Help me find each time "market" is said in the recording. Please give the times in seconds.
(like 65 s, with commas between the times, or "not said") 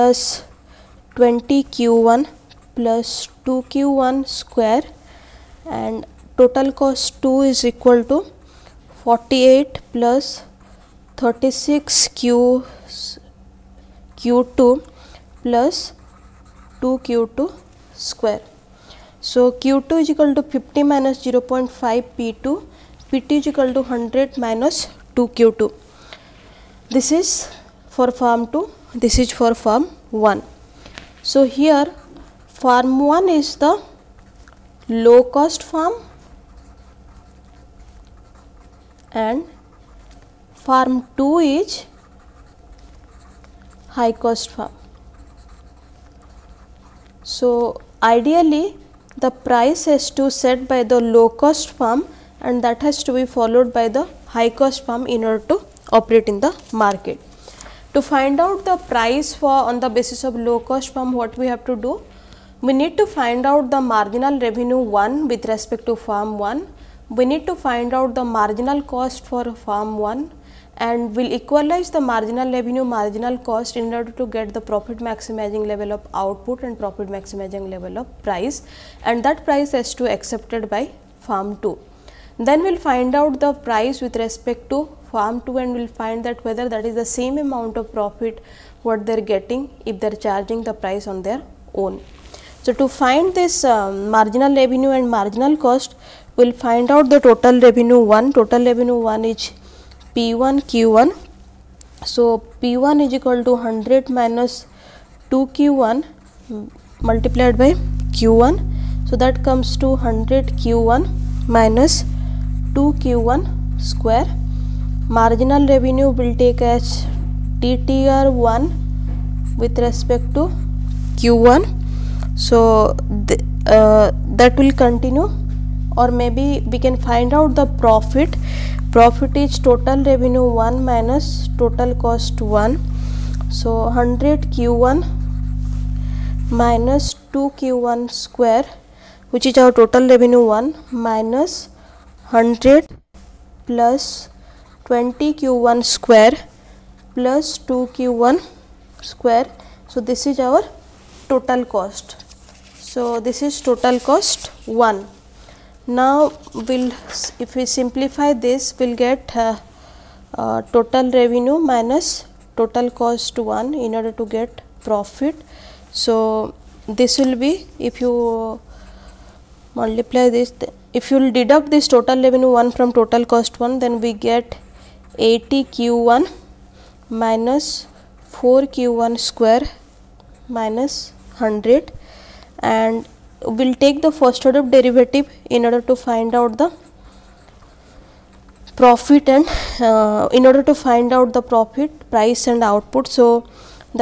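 56 s.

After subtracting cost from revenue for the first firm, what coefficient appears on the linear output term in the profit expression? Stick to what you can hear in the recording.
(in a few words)
80.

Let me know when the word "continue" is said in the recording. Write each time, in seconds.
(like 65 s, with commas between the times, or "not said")
124 s.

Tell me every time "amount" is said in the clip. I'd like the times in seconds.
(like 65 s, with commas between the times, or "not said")
87 s.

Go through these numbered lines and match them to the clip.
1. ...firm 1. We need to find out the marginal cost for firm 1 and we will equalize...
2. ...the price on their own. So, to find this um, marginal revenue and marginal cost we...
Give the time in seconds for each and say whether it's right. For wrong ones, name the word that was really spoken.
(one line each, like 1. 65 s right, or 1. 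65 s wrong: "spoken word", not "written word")
1. 65 s right
2. 90 s right.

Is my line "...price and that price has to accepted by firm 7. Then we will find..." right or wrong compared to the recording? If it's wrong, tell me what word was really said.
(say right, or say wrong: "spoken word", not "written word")
wrong: "2", not "7".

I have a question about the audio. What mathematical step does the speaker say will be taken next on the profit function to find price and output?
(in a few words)
first order derivative.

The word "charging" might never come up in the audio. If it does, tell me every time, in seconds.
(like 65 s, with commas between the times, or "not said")
90 s.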